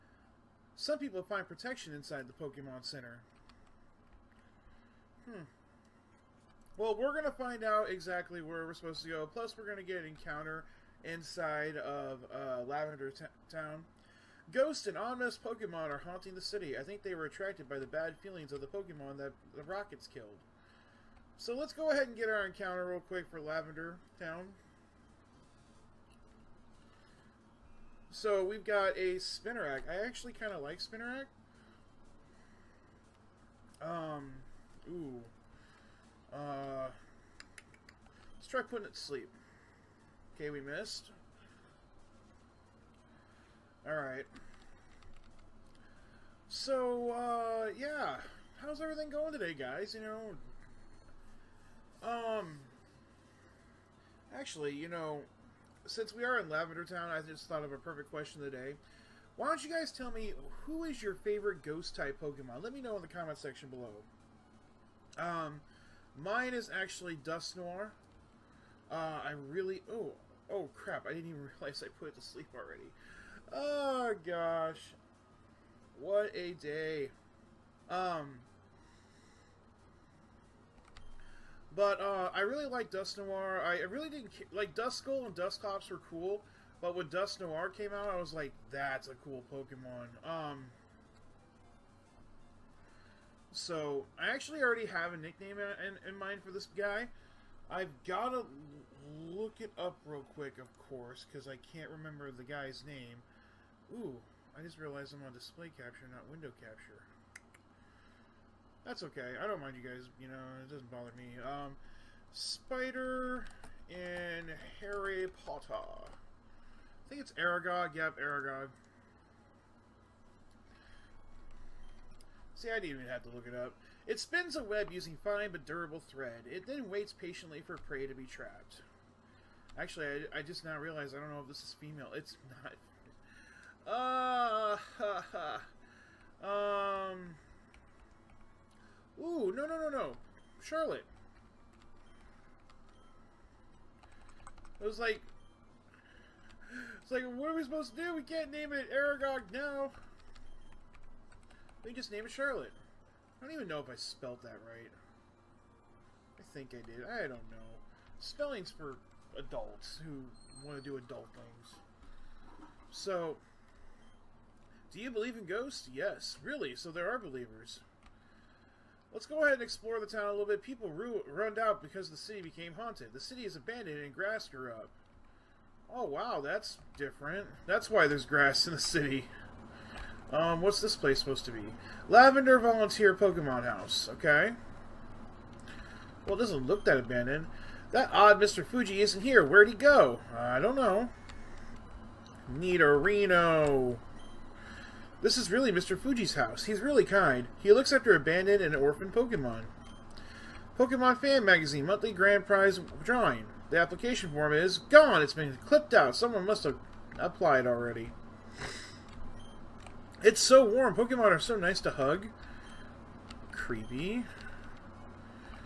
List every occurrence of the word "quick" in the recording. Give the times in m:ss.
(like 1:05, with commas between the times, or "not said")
0:23, 1:40.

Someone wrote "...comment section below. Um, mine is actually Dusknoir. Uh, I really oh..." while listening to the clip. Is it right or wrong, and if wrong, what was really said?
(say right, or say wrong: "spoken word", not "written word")
right.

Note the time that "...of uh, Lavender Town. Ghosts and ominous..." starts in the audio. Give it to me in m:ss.
0:11.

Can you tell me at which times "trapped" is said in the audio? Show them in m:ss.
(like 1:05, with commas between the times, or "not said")
2:08.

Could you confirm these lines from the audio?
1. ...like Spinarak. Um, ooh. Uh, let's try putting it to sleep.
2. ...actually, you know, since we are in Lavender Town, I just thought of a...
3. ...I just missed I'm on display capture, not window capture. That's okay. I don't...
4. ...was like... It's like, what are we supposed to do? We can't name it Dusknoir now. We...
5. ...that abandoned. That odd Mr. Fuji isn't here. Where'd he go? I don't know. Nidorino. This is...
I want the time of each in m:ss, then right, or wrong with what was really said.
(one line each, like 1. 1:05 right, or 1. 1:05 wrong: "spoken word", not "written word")
1. 0:30 right
2. 0:54 right
3. 1:44 wrong: "realized", not "missed"
4. 2:24 wrong: "Aragog", not "Dusknoir"
5. 3:06 right.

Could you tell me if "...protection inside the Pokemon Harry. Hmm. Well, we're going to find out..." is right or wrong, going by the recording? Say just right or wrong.
wrong.